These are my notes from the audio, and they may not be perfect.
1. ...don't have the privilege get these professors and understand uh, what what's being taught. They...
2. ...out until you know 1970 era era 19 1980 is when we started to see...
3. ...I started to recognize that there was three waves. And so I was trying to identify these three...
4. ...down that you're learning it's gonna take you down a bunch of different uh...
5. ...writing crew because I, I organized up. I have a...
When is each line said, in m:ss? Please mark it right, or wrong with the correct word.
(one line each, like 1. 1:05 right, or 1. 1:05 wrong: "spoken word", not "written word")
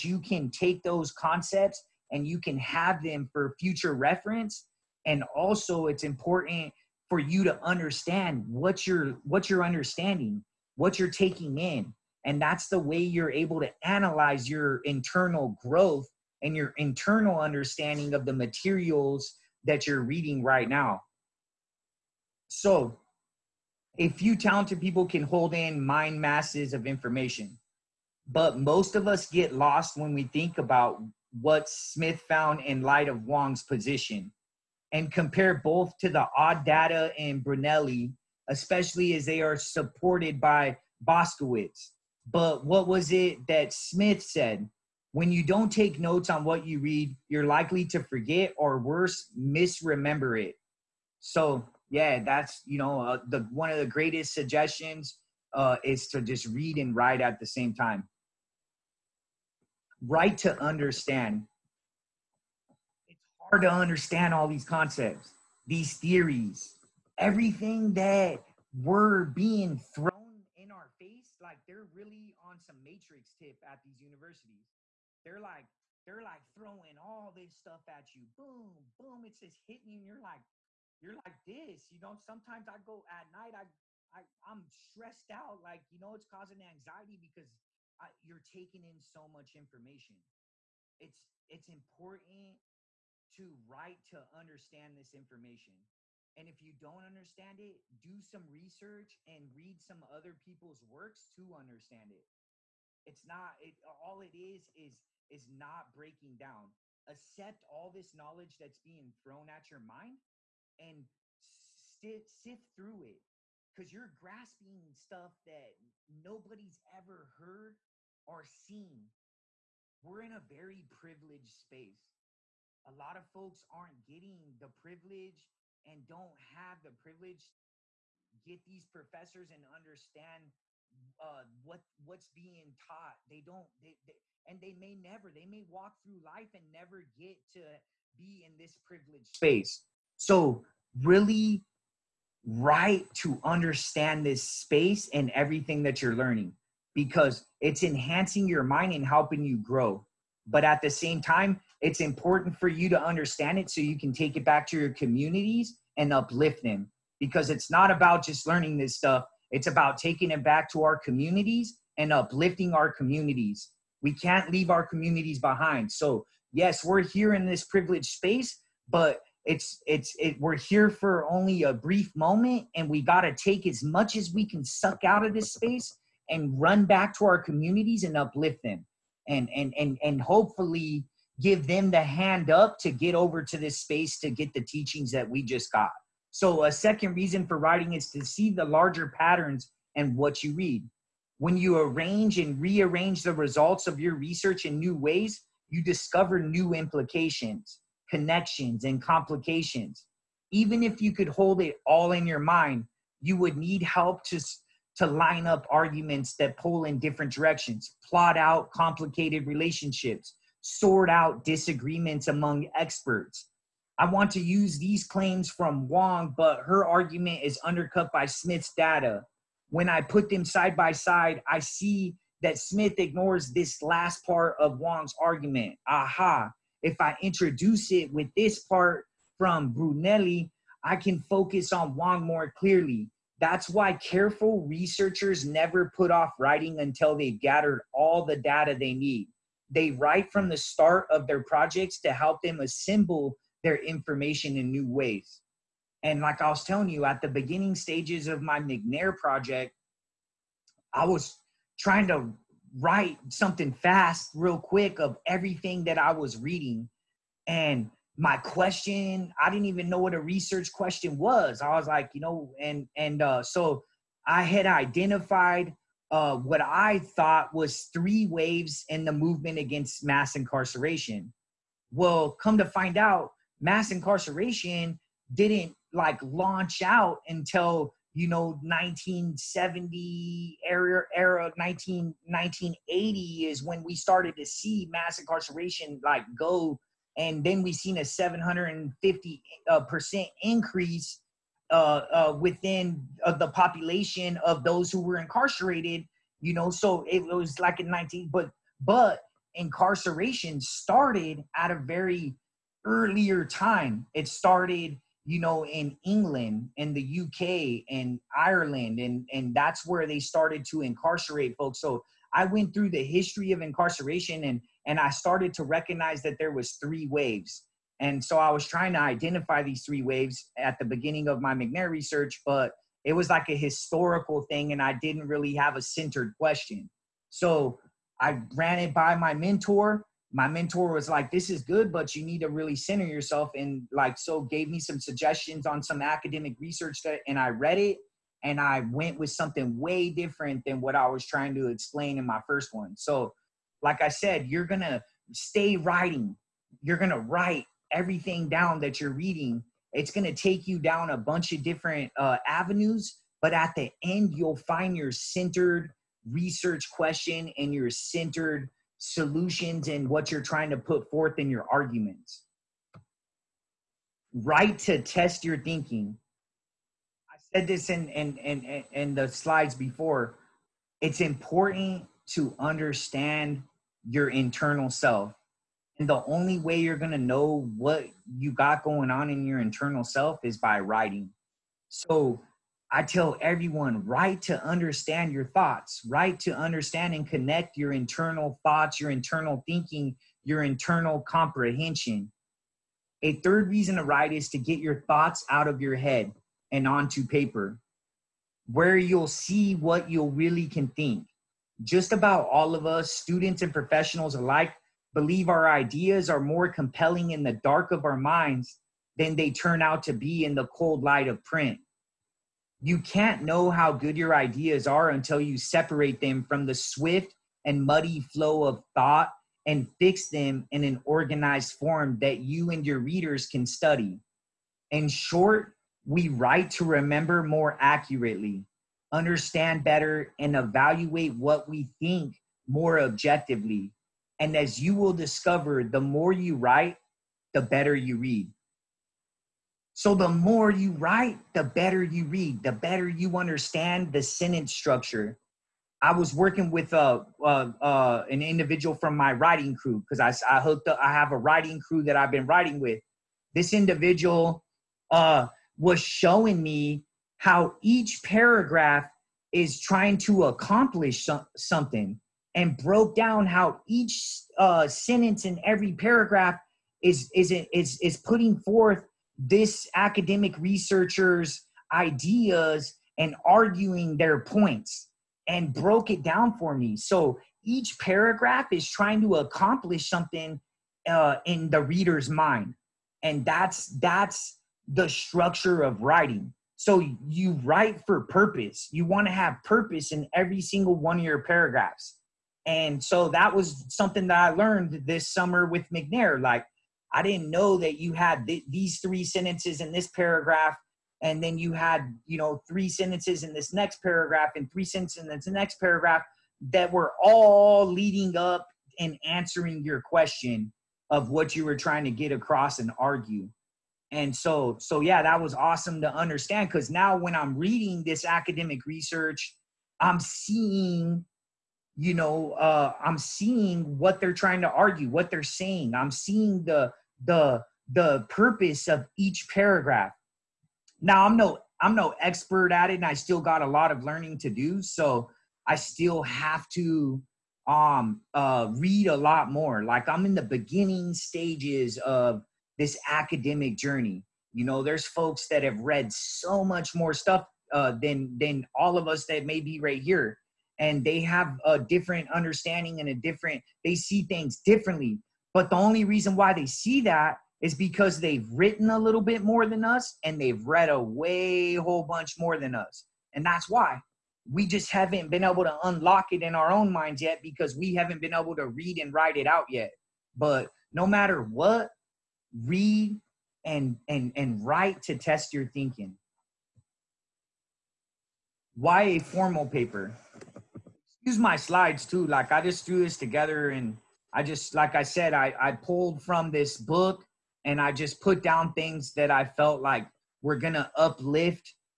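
1. 2:06 right
2. 4:36 right
3. 5:14 right
4. 5:48 wrong: "reading", not "learning"
5. 7:29 wrong: "hooked", not "organized".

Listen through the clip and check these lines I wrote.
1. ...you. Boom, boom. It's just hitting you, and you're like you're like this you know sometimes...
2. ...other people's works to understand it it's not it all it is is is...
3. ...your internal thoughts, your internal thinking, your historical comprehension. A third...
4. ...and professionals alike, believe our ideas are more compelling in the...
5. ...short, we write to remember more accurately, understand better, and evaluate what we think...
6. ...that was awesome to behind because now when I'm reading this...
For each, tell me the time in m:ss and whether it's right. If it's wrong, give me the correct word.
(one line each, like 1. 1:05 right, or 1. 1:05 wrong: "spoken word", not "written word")
1. 1:18 right
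2. 1:40 right
3. 6:27 wrong: "internal", not "historical"
4. 6:43 right
5. 7:05 right
6. 8:35 wrong: "understand", not "behind".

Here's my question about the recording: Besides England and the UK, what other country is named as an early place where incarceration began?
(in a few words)
Ireland.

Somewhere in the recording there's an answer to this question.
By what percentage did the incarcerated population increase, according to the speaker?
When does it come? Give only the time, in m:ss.
4:48.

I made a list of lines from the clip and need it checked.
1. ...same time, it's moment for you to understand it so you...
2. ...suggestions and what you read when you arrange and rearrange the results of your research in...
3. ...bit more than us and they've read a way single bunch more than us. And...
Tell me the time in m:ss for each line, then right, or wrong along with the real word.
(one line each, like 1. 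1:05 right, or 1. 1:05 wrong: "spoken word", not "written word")
1. 2:30 wrong: "important", not "moment"
2. 3:09 wrong: "patterns", not "suggestions"
3. 9:19 wrong: "whole", not "single".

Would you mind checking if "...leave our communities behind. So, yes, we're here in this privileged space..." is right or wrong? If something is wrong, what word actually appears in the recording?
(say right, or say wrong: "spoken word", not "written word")
right.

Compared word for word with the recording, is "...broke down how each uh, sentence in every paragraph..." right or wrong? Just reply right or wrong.
right.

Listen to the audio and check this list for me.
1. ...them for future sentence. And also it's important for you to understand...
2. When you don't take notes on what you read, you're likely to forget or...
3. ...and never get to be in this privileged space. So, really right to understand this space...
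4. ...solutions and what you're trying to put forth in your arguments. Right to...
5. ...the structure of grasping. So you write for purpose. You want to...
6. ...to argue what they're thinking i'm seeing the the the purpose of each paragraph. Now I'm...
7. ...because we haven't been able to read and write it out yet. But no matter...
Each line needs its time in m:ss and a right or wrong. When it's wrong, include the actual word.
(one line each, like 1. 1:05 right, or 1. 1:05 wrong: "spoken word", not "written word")
1. 0:03 wrong: "reference", not "sentence"
2. 0:45 right
3. 2:16 right
4. 5:59 right
5. 8:04 wrong: "writing", not "grasping"
6. 8:44 wrong: "saying", not "thinking"
7. 9:27 right.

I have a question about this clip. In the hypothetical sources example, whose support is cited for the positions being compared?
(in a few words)
Boskowitz.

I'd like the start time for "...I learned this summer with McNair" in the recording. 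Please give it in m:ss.
8:14.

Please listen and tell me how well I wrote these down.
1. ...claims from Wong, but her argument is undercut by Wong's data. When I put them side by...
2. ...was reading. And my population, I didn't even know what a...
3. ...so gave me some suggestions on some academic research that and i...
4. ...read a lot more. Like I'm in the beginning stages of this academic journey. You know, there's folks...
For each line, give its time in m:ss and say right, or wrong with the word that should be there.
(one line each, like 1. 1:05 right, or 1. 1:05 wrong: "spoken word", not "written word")
1. 3:35 wrong: "Smith", not "Wong"
2. 4:16 wrong: "question", not "population"
3. 5:34 right
4. 8:58 right.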